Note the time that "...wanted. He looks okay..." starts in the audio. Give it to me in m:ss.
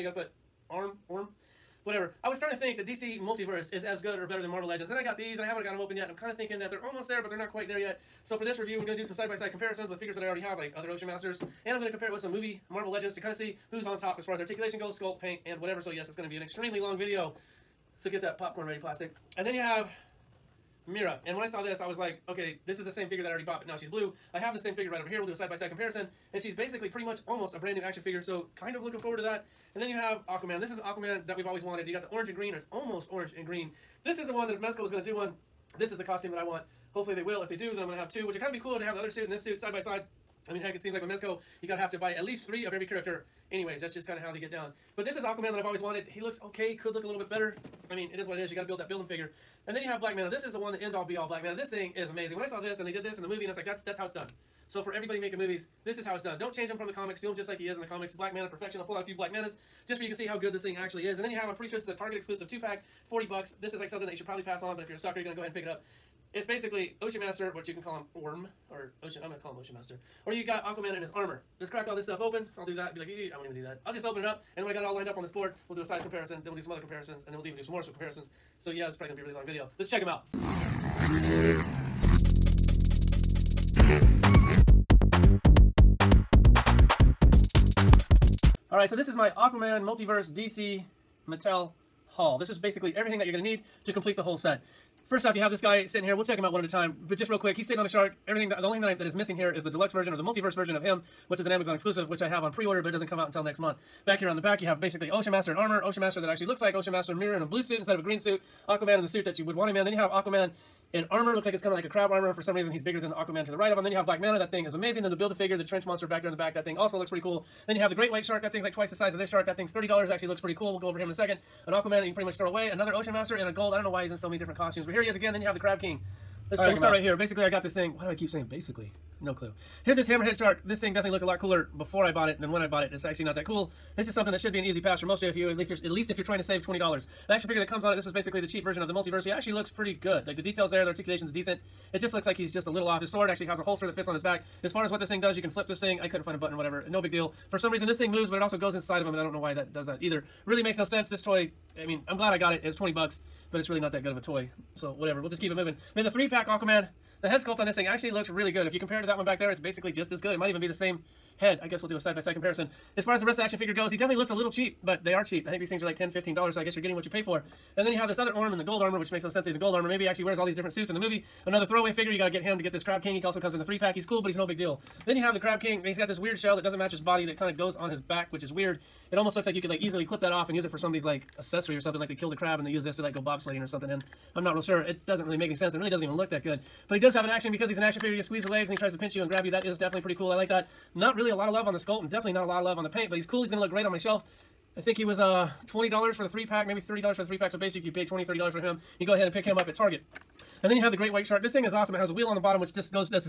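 0:45.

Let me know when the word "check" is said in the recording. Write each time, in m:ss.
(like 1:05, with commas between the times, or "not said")
1:19, 1:36, 2:06.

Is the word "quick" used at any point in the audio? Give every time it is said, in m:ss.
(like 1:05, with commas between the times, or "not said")
1:37.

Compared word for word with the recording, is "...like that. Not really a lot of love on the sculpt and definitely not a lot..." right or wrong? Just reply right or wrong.
right.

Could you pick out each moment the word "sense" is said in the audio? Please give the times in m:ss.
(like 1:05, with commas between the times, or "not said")
2:30, 2:49, 3:05.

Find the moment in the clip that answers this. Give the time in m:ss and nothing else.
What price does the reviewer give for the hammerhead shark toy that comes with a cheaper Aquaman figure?
2:32.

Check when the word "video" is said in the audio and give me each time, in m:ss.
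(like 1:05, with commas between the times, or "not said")
0:17, 1:19.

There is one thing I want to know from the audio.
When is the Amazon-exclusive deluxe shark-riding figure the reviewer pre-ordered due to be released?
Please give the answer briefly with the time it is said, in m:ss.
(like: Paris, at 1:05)
next month, at 1:43.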